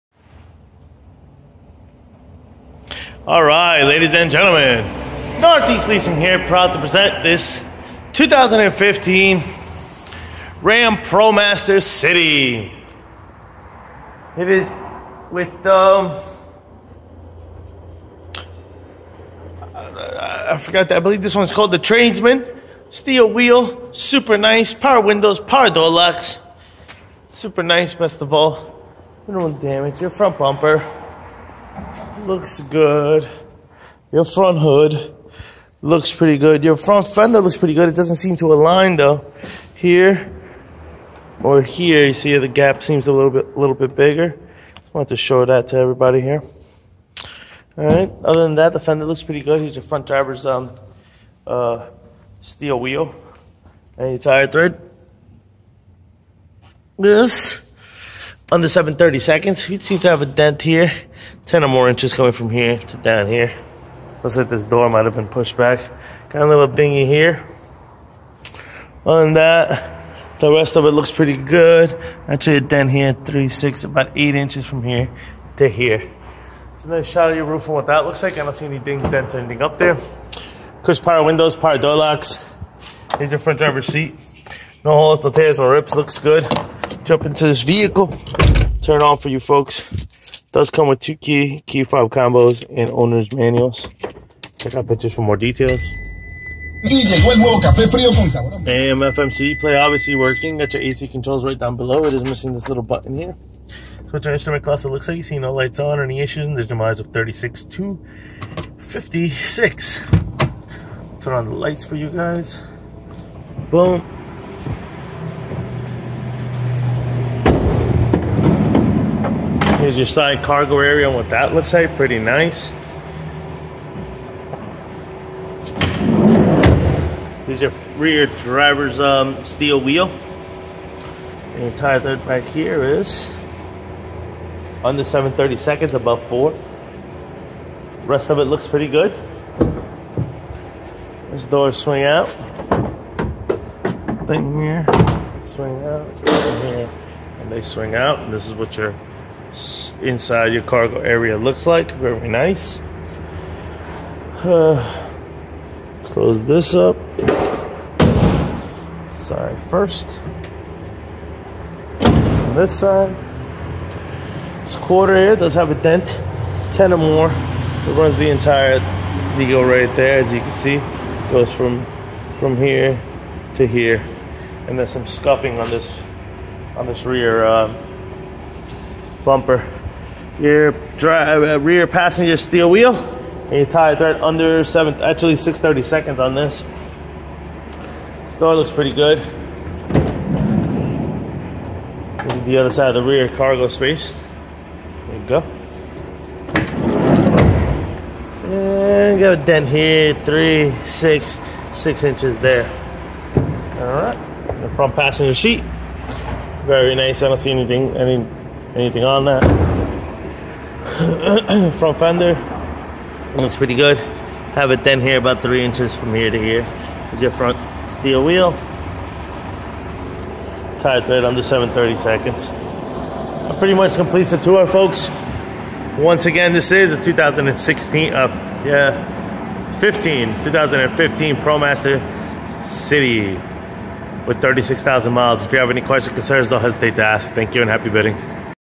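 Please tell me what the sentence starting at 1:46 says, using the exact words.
And there's demise of 36 to 56.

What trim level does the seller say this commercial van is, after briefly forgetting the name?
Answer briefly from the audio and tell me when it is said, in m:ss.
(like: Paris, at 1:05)
Tradesman, at 0:21.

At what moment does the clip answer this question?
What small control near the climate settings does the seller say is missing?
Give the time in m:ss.
1:42.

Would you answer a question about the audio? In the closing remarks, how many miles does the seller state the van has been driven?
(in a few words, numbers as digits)
36,000.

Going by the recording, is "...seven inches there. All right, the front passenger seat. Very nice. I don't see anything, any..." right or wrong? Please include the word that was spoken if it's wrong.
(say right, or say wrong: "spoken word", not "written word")
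wrong: "six", not "seven".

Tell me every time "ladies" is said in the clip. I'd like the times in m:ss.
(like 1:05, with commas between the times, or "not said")
0:03.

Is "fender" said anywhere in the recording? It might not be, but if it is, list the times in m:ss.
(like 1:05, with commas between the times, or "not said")
0:37, 0:48, 3:31.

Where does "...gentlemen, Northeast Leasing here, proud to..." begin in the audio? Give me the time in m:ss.
0:04.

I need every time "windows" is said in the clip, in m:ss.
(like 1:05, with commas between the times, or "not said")
0:24, 1:21.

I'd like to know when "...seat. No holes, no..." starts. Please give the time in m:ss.
1:23.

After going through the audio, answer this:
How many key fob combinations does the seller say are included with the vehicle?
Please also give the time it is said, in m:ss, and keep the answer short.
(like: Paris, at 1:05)
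2, at 1:30.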